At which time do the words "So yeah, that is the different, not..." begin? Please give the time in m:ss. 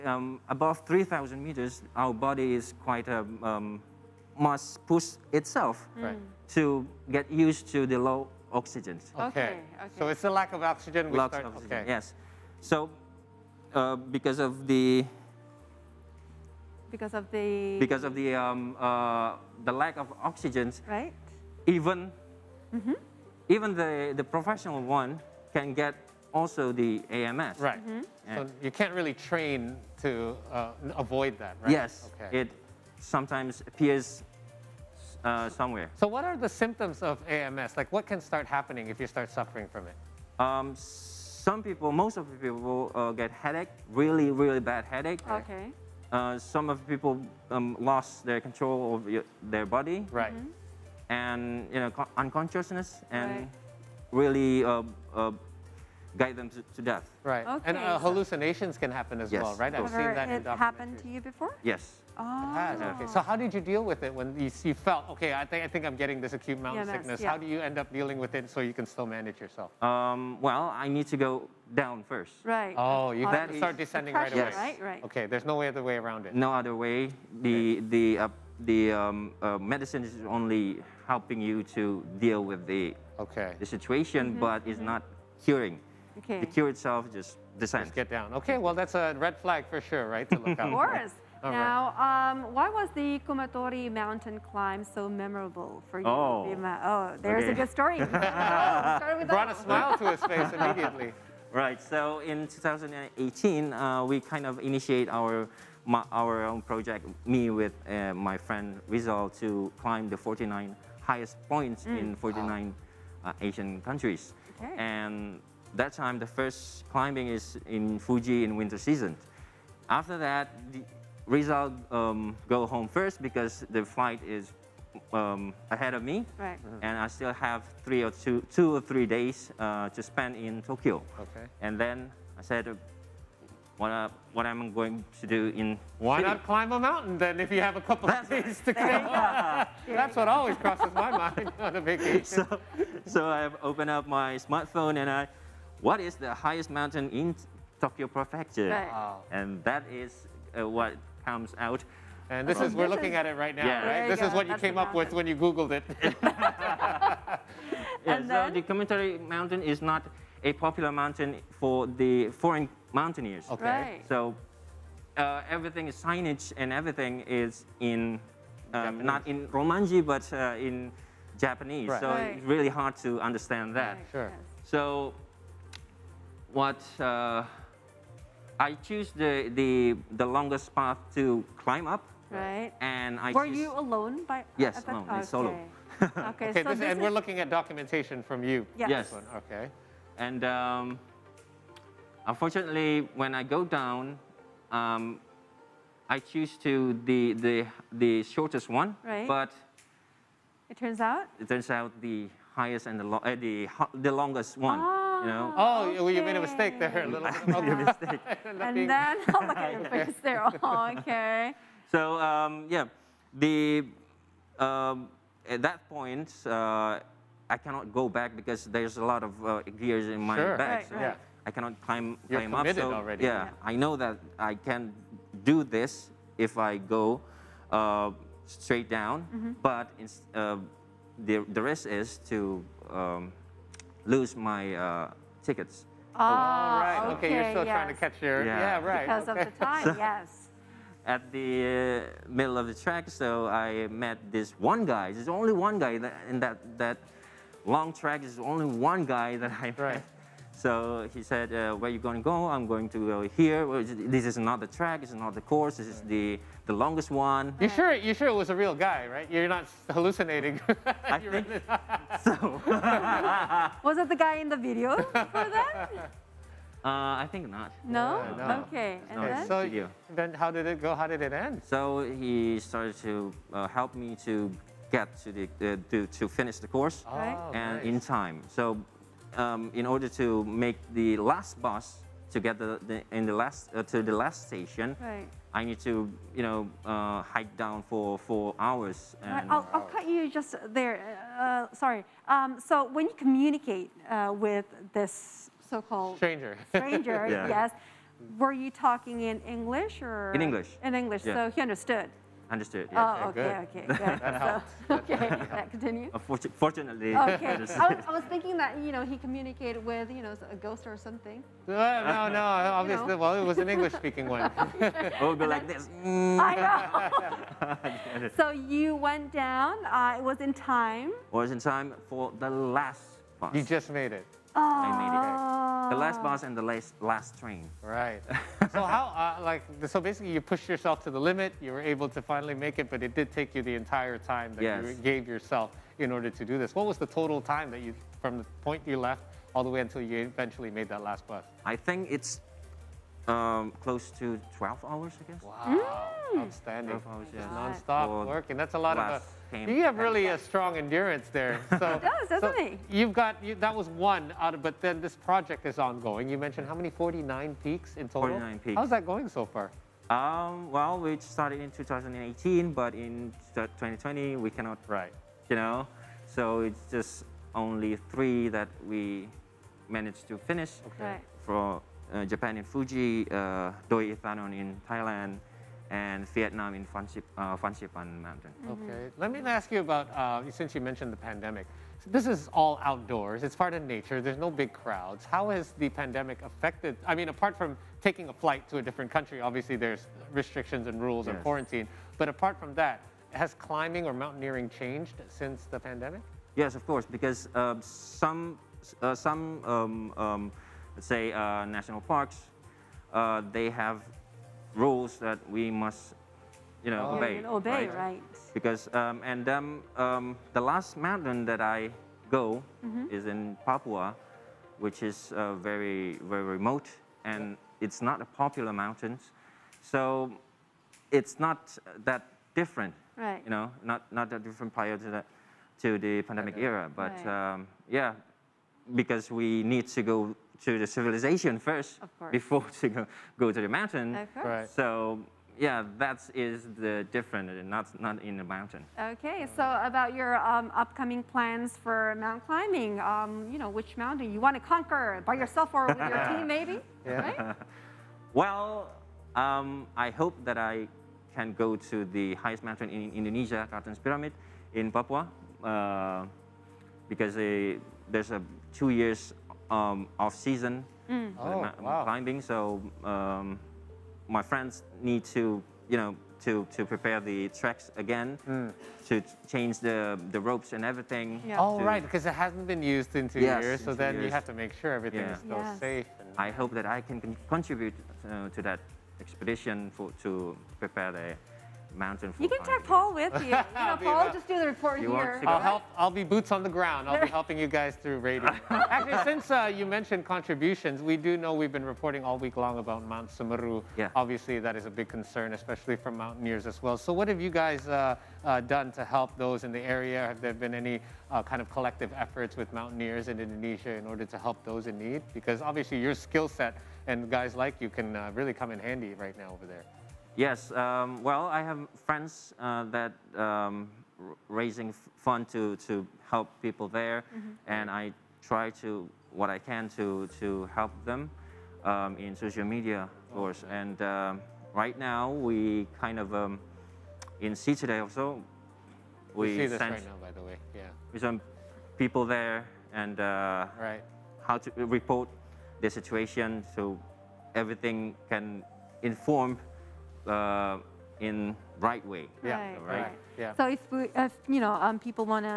7:14.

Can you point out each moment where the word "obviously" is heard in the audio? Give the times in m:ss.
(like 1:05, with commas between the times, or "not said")
5:12, 6:29, 8:14, 8:25.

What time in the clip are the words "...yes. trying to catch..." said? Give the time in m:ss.
3:57.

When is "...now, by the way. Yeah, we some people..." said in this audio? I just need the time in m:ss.
8:50.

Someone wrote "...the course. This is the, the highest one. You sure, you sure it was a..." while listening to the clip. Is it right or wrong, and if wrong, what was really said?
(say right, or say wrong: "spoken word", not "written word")
wrong: "longest", not "highest".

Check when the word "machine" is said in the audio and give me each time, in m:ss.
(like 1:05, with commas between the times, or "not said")
not said.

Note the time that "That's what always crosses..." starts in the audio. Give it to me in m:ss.
2:19.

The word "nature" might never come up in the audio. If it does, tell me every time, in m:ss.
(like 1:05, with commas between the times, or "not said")
6:23.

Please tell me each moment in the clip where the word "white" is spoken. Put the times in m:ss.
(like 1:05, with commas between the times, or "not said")
not said.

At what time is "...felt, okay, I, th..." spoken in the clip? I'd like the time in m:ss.
1:04.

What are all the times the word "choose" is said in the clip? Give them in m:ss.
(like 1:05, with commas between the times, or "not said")
2:58, 3:03, 3:16.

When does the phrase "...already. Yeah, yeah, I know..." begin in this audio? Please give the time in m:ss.
3:42.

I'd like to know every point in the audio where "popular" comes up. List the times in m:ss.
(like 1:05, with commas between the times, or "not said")
2:40, 6:58.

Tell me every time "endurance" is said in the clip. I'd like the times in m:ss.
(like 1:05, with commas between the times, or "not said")
5:50.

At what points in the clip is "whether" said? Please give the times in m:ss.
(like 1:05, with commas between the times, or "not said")
not said.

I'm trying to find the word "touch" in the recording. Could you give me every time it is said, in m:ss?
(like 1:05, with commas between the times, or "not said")
not said.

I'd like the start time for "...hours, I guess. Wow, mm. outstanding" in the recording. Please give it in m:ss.
5:44.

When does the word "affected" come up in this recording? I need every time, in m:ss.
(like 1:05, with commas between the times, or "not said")
6:26.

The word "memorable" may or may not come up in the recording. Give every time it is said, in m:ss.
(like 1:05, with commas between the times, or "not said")
1:35.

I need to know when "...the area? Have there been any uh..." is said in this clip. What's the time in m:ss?
8:19.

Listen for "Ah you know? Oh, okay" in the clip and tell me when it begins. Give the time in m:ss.
3:24.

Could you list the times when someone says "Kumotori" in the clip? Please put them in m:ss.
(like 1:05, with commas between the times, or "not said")
1:33, 2:38.